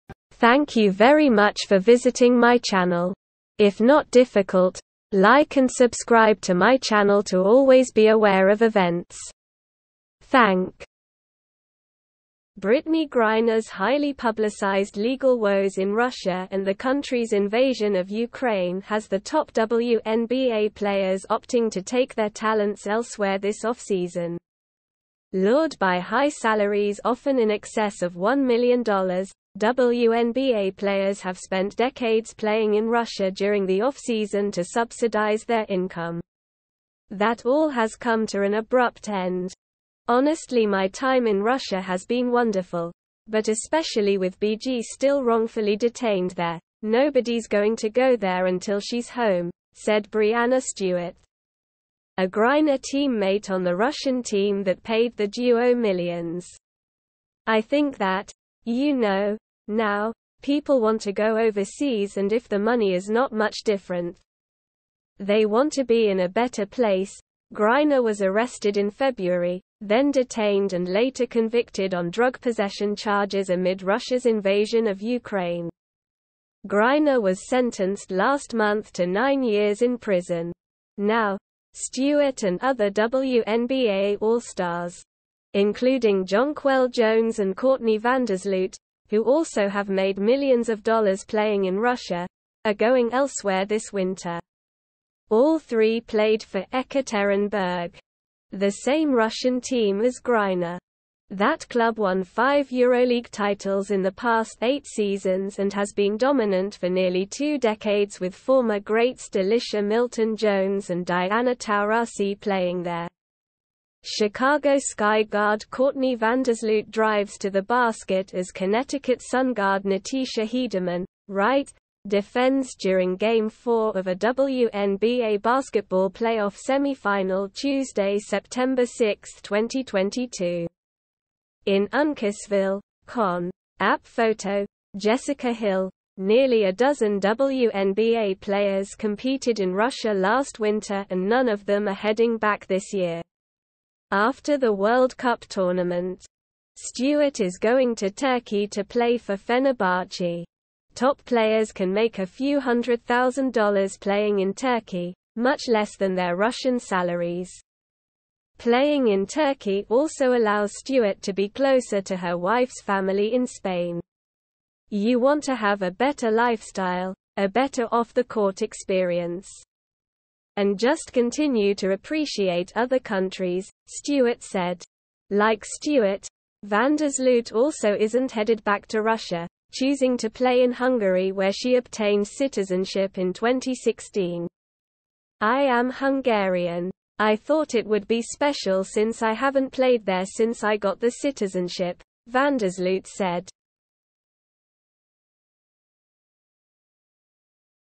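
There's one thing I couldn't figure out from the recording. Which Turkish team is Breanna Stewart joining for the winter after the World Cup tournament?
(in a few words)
Fenerbahce.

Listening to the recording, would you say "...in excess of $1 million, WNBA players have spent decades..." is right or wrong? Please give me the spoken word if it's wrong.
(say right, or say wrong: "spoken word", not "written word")
right.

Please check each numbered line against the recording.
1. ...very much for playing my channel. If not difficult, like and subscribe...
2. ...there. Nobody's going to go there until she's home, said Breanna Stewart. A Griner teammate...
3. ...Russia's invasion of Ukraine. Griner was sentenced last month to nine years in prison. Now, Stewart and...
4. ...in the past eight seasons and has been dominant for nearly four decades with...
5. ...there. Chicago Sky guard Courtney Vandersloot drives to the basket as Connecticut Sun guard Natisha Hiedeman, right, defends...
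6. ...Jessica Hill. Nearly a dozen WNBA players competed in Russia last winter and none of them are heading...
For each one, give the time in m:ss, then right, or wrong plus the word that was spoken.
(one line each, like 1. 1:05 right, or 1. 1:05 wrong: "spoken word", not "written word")
1. 0:00 wrong: "visiting", not "playing"
2. 0:46 right
3. 1:13 right
4. 1:43 wrong: "two", not "four"
5. 1:52 right
6. 2:14 right.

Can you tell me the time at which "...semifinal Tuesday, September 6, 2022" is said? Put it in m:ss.
2:06.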